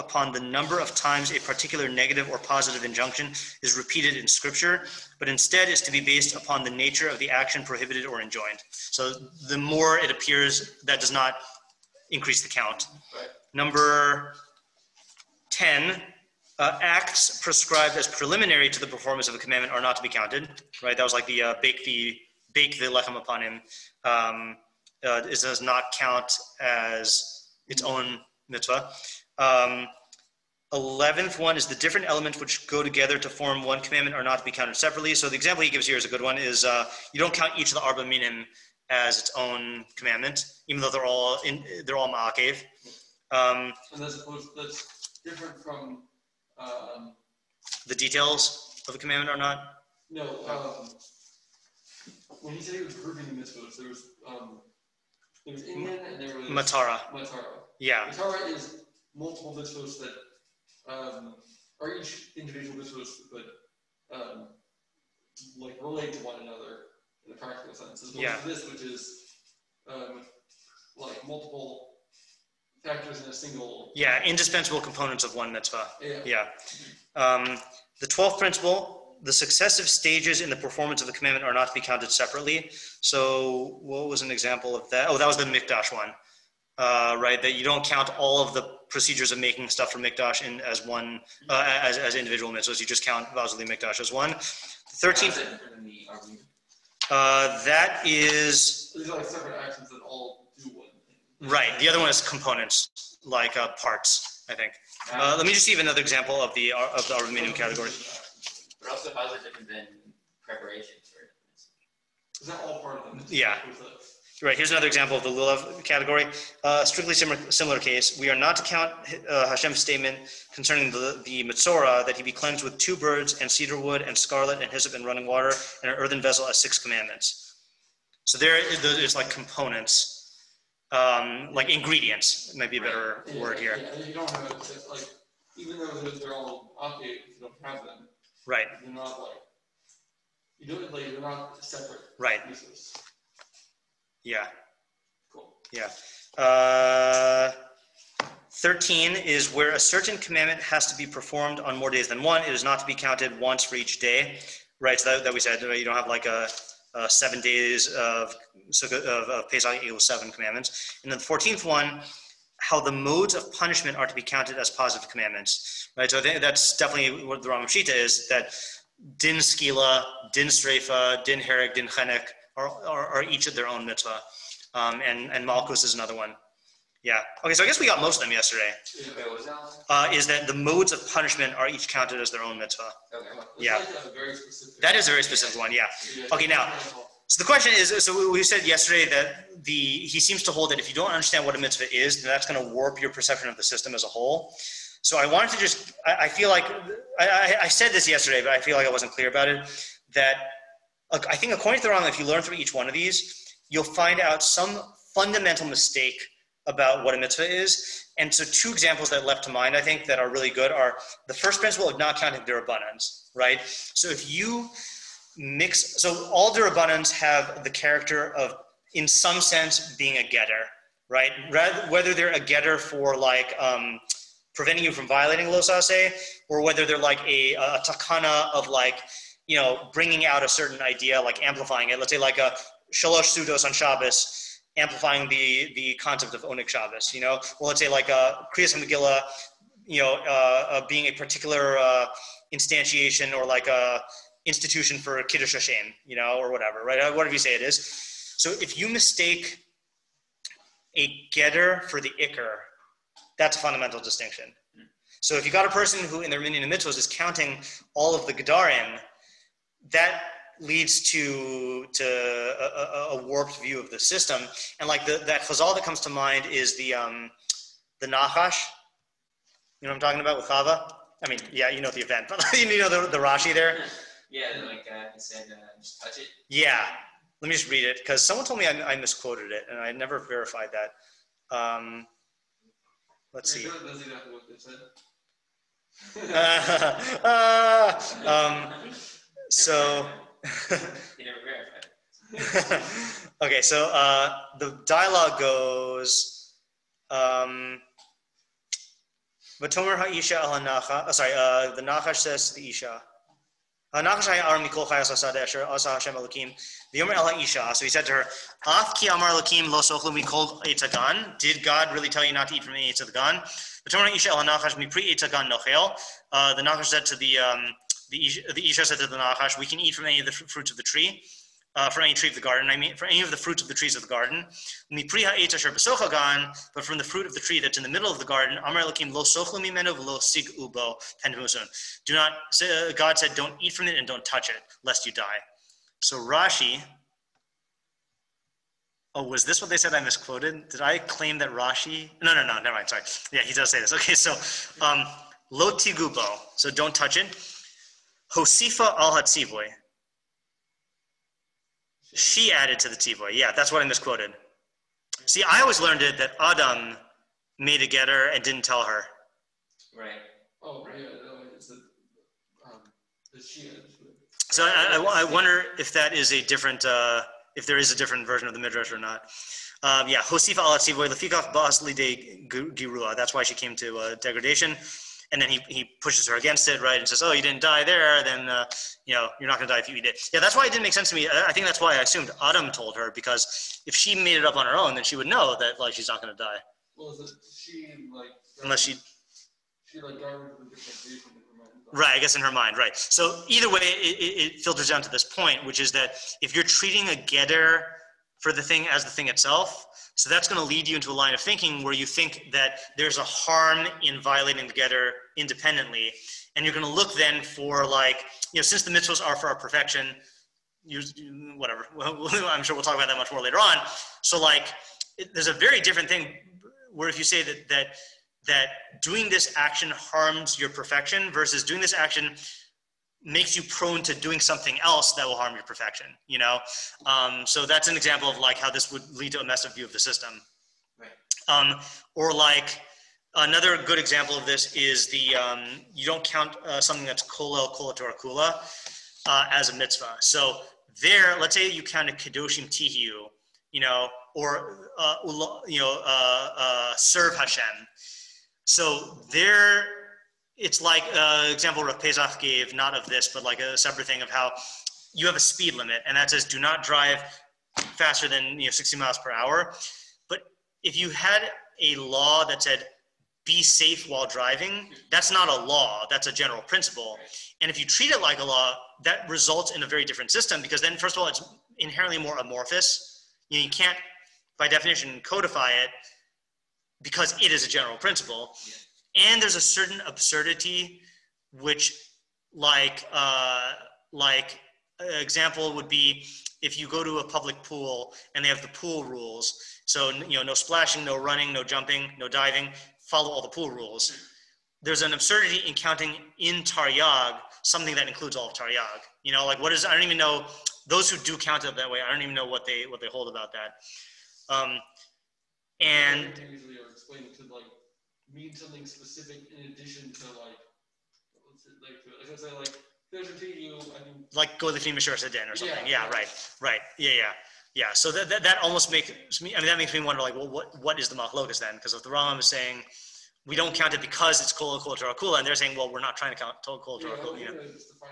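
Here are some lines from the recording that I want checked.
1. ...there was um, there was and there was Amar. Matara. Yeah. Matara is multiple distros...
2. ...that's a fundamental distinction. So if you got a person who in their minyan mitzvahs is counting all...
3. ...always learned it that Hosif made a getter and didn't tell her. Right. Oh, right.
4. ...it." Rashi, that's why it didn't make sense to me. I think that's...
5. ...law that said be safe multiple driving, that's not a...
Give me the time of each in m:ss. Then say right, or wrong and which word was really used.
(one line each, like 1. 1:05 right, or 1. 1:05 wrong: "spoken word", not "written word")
1. 0:53 wrong: "Matara", not "Amar"
2. 4:13 right
3. 5:55 wrong: "Adam", not "Hosif"
4. 6:20 wrong: "Yeah", not "Rashi"
5. 7:41 wrong: "while", not "multiple".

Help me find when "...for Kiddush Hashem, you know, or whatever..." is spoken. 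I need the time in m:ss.
4:04.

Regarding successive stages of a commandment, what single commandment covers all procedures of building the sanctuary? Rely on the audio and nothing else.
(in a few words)
Vazuli Mikdash.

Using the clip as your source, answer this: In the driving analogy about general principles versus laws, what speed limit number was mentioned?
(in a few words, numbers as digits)
60 miles per hour.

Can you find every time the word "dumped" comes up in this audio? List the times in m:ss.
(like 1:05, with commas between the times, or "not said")
not said.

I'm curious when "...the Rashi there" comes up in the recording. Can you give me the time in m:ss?
4:33.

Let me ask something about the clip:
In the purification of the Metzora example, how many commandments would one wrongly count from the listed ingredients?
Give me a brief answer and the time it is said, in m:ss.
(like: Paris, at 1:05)
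6, at 2:06.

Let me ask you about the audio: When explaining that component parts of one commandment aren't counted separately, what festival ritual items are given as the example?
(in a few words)
Arba Minim.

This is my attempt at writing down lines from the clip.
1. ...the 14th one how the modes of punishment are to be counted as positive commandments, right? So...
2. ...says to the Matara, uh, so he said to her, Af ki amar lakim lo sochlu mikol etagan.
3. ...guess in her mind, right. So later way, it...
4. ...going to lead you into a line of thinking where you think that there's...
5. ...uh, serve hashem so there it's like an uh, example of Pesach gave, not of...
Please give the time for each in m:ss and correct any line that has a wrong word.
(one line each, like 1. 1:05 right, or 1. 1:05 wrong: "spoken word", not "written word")
1. 2:41 right
2. 5:02 wrong: "Isha", not "Matara"
3. 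6:32 wrong: "either", not "later"
4. 6:40 right
5. 7:26 right.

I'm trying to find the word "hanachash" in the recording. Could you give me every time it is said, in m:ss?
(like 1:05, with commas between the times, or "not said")
5:14.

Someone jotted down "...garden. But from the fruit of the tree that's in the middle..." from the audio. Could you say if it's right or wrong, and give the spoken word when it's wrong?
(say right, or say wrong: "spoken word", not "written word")
right.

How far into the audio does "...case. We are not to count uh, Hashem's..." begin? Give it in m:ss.
1:57.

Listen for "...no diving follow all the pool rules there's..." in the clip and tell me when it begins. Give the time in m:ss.
8:12.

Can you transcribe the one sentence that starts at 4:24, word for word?
And like the, that chazal that comes to mind is the um, the nachash.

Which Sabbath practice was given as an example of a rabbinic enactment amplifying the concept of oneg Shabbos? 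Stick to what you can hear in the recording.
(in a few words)
Shalosh sudos.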